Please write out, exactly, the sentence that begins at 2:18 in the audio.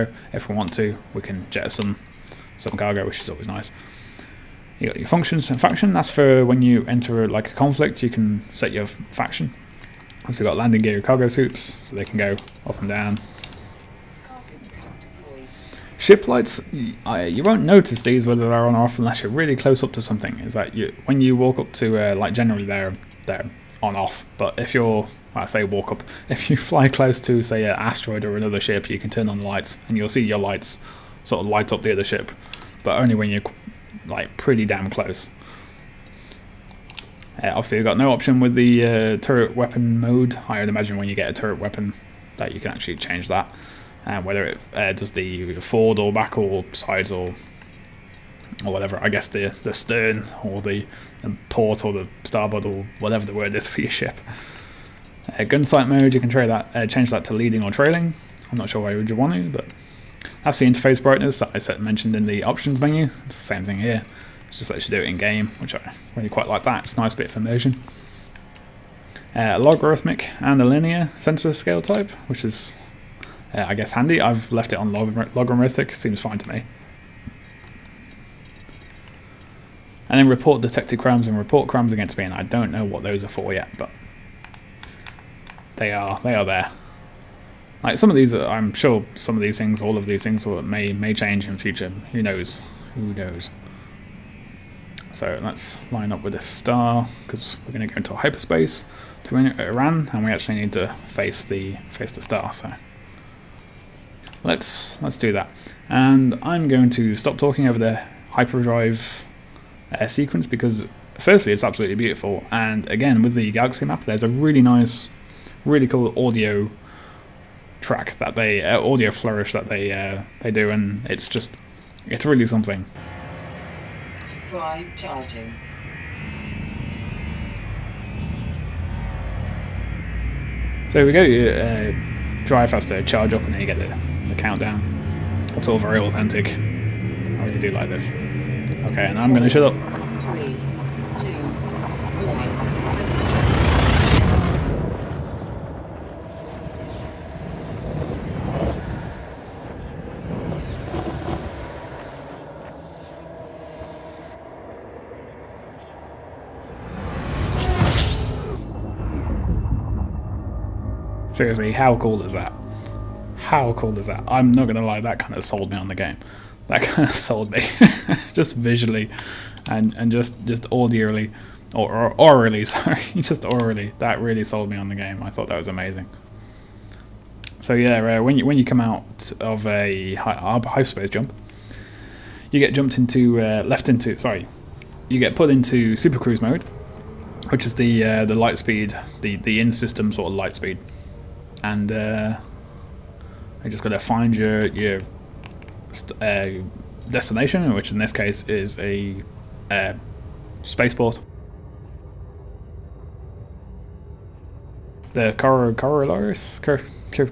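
Okay, and I'm gonna shut up.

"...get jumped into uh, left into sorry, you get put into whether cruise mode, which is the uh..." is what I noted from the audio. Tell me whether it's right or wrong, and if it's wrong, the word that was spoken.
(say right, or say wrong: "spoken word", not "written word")
wrong: "super", not "whether".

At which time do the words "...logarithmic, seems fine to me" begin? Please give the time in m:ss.
1:15.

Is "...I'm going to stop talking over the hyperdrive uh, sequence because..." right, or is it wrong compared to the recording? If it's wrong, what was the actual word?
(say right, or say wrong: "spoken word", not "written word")
right.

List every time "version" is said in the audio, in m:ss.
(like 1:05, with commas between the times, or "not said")
not said.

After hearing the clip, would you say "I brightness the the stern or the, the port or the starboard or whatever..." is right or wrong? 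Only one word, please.
wrong.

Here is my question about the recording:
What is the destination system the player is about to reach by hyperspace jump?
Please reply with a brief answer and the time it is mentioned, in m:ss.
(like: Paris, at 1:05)
Iran, at 1:39.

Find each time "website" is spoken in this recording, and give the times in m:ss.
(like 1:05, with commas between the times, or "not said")
not said.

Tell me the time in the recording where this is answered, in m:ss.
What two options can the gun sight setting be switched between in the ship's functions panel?
0:57.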